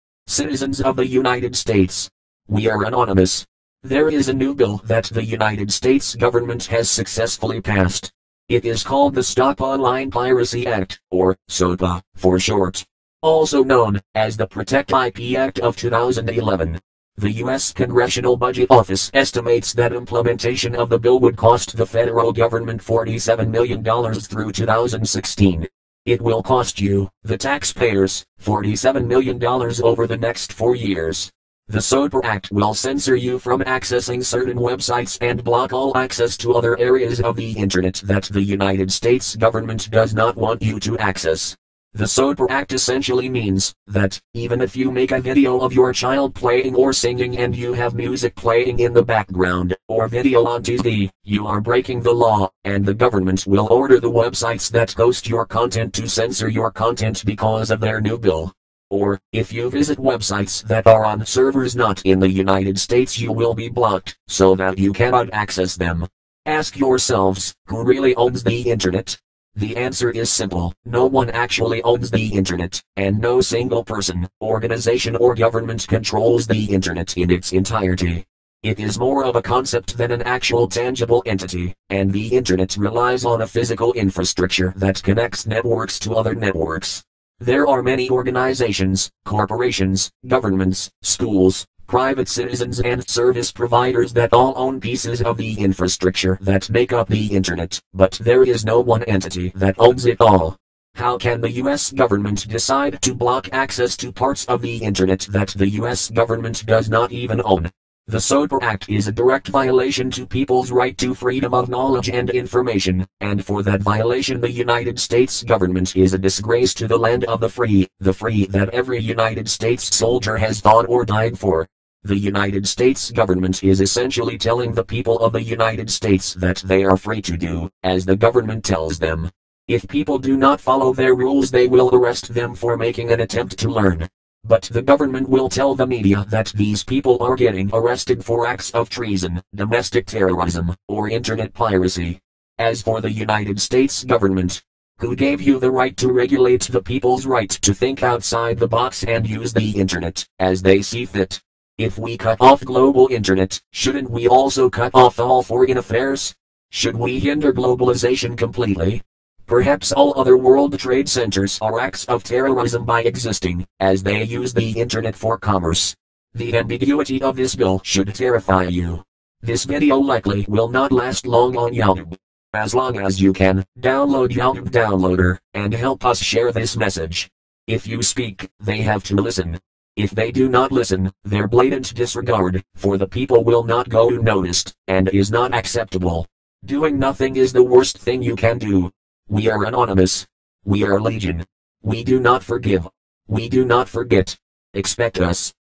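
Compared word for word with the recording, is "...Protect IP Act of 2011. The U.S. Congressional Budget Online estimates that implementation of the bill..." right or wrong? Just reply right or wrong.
wrong.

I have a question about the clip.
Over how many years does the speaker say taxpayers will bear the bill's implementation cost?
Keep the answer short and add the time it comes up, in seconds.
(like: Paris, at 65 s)
4, at 30 s.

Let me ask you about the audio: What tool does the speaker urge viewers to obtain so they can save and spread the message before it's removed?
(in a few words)
YouTube Downloader.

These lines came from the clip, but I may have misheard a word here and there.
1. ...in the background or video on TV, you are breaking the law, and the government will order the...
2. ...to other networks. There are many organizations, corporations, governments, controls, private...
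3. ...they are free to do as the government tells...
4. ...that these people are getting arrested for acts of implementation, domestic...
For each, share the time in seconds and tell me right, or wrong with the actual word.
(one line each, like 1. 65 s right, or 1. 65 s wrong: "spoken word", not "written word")
1. 48 s right
2. 85 s wrong: "schools", not "controls"
3. 126 s right
4. 136 s wrong: "treason", not "implementation".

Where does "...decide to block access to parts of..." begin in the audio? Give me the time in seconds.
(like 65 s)
102 s.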